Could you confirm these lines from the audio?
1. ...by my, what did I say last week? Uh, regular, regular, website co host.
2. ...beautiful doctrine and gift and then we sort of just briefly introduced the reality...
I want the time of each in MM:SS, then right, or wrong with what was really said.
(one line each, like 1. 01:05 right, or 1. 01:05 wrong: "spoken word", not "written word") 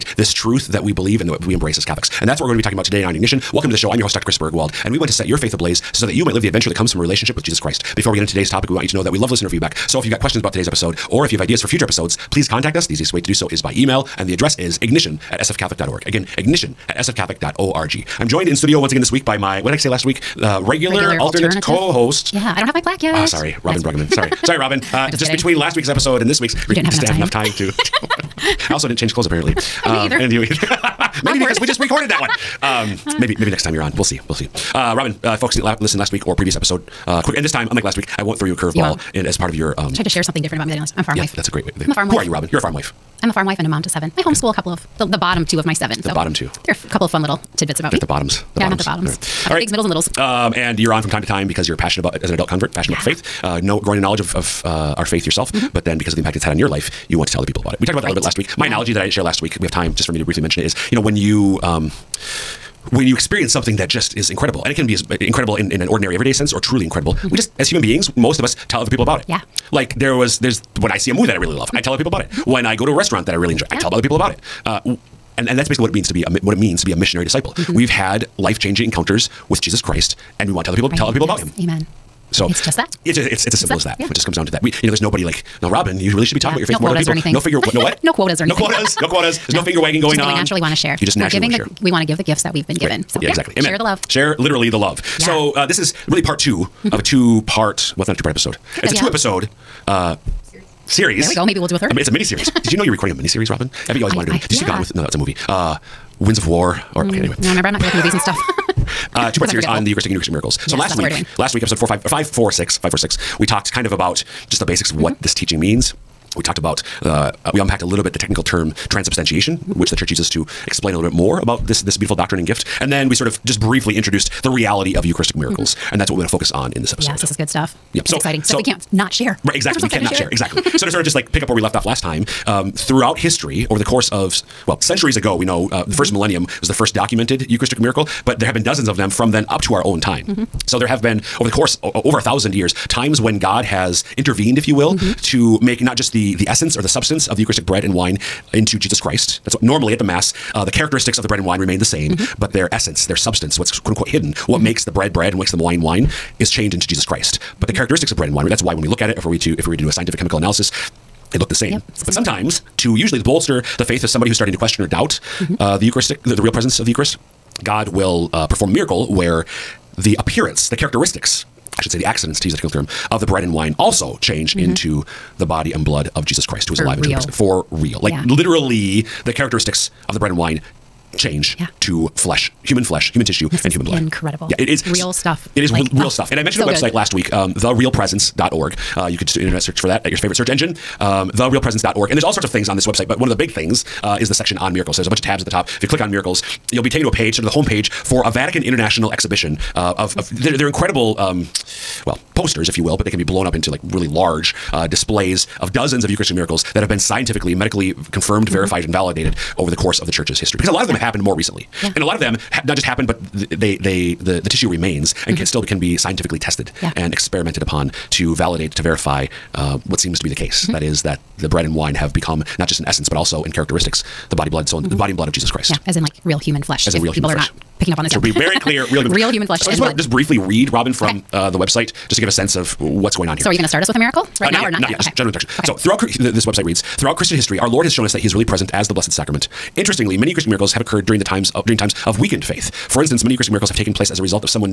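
1. 00:19 wrong: "alternate", not "website"
2. 02:01 right.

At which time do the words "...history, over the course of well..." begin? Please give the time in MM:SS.
02:13.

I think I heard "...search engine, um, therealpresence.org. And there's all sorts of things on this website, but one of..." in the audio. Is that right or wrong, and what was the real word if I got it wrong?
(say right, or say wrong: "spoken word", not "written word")
right.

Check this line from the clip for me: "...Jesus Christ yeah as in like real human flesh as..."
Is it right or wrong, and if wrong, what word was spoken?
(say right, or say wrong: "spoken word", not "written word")
right.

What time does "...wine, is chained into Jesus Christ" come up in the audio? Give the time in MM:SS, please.
02:35.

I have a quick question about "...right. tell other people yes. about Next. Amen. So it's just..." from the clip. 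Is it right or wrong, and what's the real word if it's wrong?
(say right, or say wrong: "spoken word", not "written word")
wrong: "Him", not "Next".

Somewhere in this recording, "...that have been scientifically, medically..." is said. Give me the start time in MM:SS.
03:26.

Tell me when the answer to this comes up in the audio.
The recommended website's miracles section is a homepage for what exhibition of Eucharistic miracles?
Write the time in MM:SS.
03:18.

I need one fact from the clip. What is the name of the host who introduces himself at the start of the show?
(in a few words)
Chris Burgwald.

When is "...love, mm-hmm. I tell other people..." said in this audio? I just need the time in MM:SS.
01:11.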